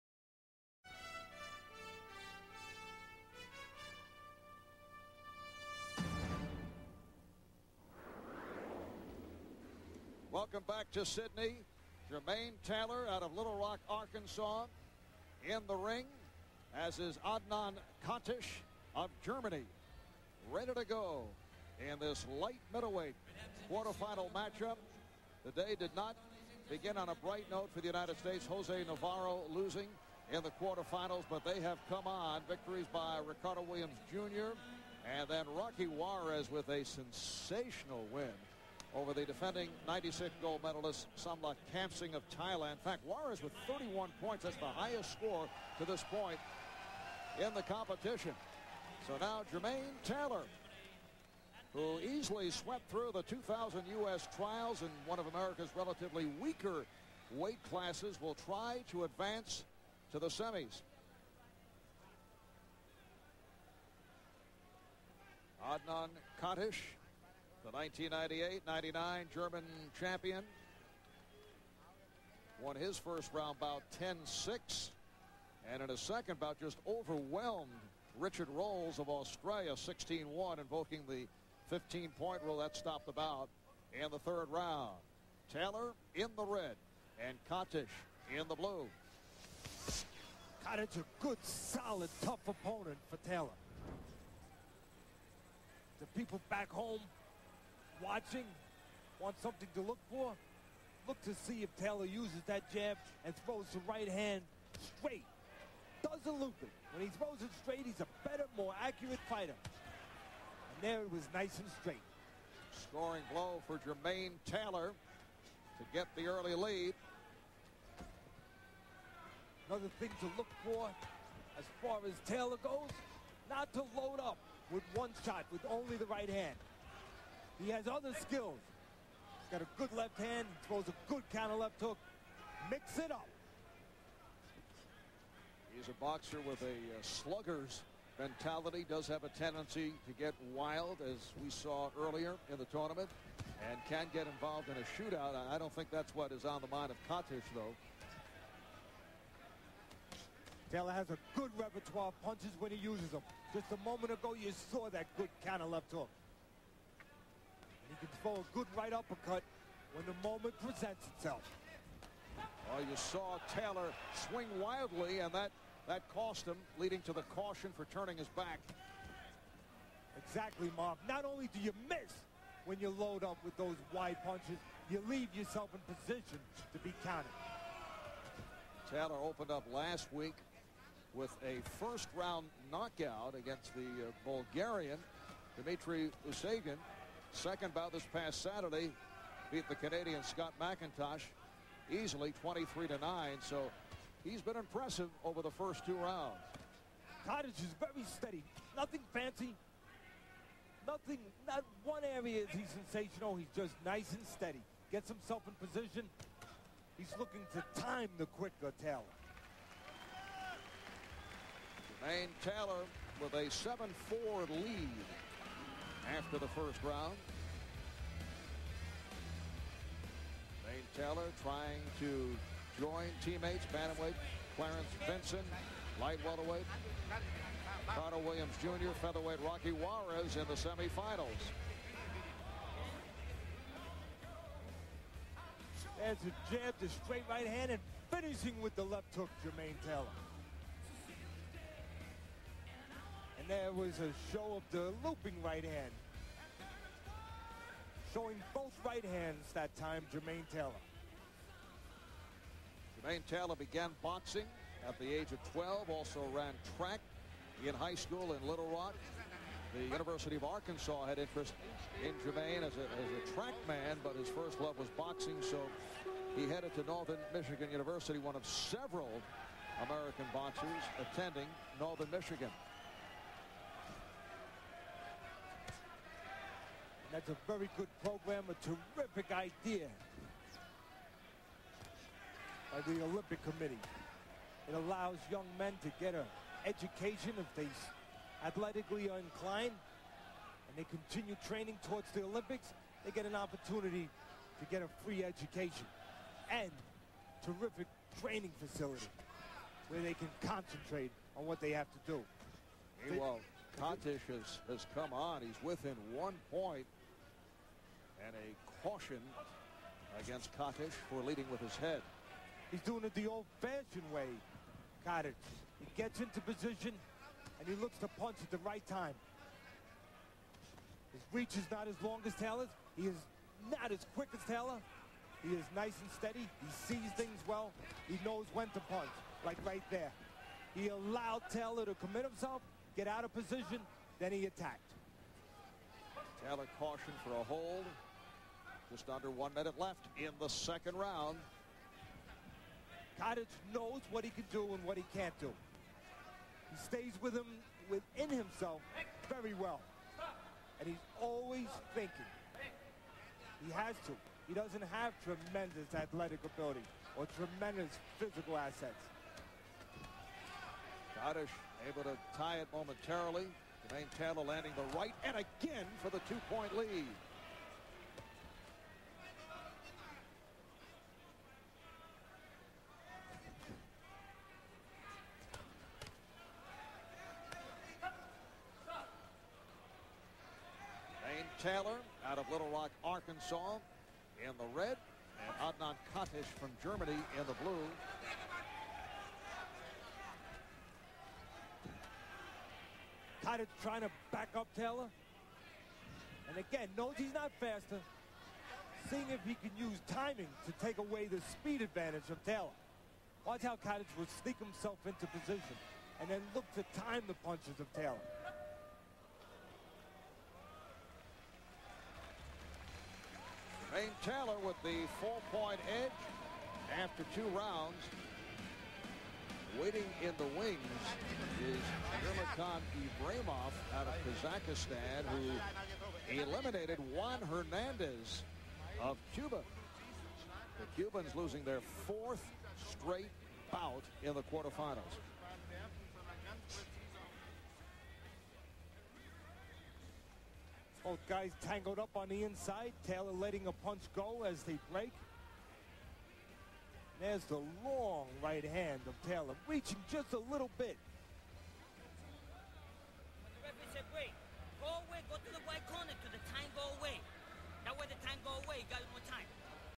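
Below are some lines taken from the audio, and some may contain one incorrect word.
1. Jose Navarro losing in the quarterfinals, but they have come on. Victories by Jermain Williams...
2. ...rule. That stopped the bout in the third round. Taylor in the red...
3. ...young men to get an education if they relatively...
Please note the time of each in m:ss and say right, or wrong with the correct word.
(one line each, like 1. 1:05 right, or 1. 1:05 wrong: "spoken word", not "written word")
1. 0:28 wrong: "Ricardo", not "Jermain"
2. 1:22 right
3. 4:45 wrong: "athletically", not "relatively".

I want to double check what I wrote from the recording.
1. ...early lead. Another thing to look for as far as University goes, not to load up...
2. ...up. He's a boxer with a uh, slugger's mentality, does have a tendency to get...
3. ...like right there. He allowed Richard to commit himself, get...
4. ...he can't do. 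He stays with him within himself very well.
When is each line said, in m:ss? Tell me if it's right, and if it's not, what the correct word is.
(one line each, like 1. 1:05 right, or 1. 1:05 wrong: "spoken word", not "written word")
1. 1:56 wrong: "Taylor", not "University"
2. 2:13 right
3. 5:29 wrong: "Taylor", not "Richard"
4. 5:44 right.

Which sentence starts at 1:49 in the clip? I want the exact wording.
And there it was nice and straight.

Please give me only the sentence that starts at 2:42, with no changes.
Well, oh, you saw Taylor swing wildly, and that, that cost him, leading to the caution for turning his back.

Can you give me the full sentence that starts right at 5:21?
His reach is not as long as Taylor's.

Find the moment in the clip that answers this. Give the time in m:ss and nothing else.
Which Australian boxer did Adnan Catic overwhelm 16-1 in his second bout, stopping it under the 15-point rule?
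1:18.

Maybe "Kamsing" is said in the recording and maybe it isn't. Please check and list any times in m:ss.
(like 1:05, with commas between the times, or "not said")
0:41.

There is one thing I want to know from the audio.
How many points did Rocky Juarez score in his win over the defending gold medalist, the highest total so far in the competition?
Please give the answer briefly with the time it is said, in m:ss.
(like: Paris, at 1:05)
31, at 0:43.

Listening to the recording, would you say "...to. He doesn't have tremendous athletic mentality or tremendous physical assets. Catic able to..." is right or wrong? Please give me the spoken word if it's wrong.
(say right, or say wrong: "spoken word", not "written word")
wrong: "ability", not "mentality".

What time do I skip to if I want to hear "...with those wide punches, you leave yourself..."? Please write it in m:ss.
2:53.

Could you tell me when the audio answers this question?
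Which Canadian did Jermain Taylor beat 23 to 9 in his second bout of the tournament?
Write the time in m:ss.
3:10.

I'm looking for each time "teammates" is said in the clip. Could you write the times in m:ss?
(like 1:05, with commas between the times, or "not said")
3:43.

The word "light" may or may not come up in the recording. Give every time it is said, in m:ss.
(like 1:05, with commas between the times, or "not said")
0:22, 3:45.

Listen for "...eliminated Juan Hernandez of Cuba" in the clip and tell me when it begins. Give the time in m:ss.
7:06.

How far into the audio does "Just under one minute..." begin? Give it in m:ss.
5:38.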